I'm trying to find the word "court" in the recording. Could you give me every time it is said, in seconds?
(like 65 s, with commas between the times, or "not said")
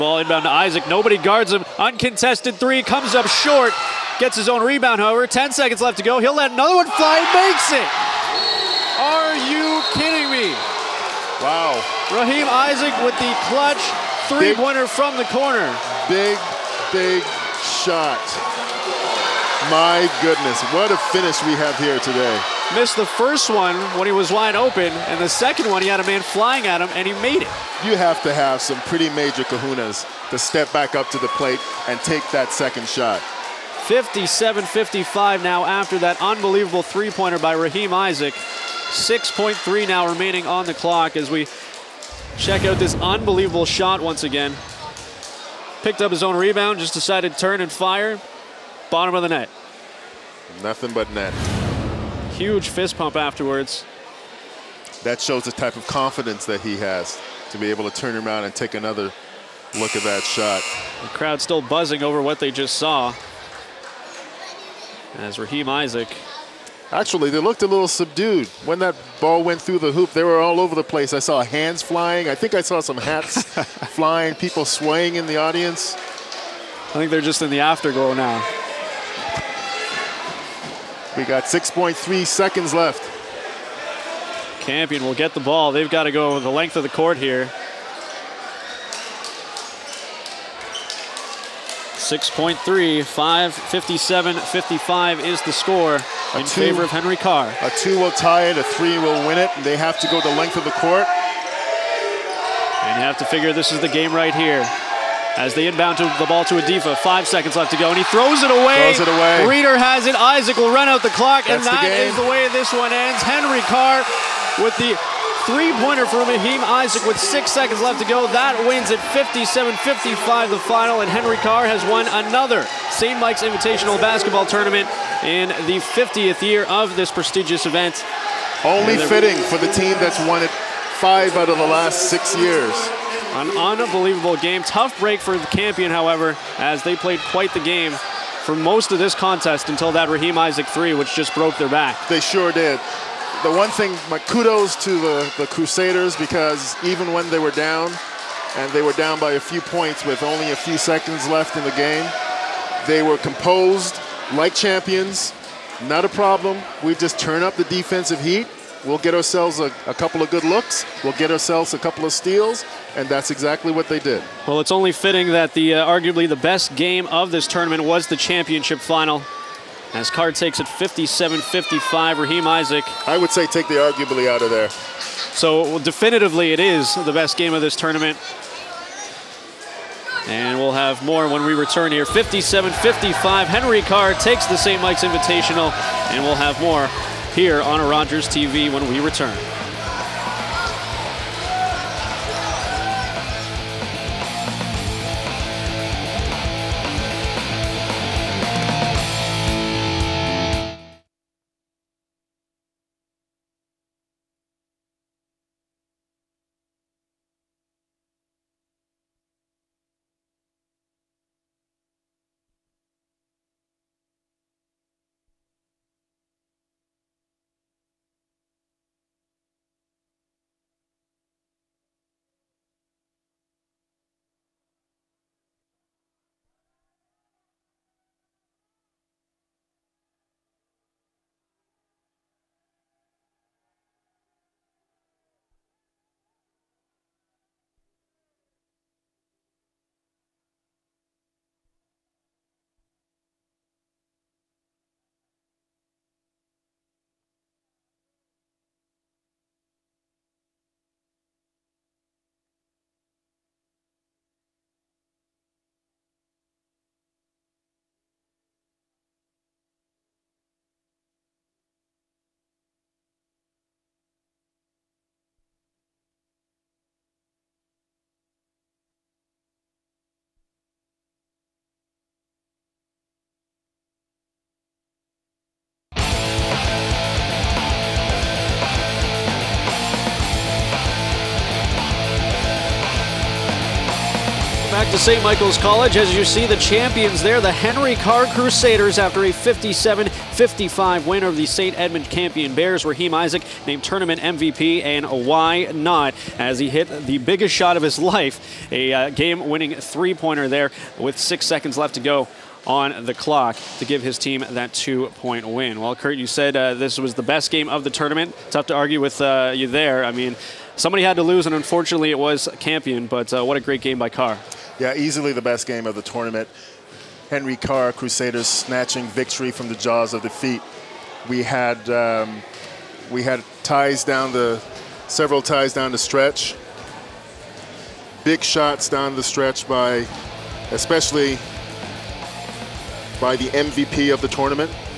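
86 s, 100 s.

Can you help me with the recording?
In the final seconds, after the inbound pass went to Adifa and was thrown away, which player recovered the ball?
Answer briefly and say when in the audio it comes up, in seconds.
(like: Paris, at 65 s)
Reeder, at 109 s.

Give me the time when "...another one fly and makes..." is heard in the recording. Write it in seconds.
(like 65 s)
6 s.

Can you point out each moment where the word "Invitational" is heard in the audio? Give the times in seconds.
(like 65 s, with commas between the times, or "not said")
123 s, 185 s.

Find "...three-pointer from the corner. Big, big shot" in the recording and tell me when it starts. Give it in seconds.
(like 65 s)
14 s.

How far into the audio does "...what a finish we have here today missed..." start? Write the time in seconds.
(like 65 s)
20 s.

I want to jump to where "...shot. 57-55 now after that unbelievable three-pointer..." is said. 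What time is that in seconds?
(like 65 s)
32 s.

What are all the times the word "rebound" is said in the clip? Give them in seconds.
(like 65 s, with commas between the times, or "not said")
4 s, 46 s.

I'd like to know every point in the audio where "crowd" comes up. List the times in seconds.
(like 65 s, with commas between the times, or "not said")
61 s.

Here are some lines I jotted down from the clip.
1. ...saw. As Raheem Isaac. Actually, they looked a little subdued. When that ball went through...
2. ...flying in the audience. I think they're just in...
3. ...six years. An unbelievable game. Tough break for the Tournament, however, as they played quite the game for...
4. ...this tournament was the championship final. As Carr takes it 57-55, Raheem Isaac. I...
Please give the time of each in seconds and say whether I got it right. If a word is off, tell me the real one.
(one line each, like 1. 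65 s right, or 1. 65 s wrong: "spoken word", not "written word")
1. 62 s right
2. 74 s wrong: "swaying", not "flying"
3. 132 s wrong: "Campion", not "Tournament"
4. 167 s right.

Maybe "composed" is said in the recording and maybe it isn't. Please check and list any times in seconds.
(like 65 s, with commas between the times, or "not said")
153 s.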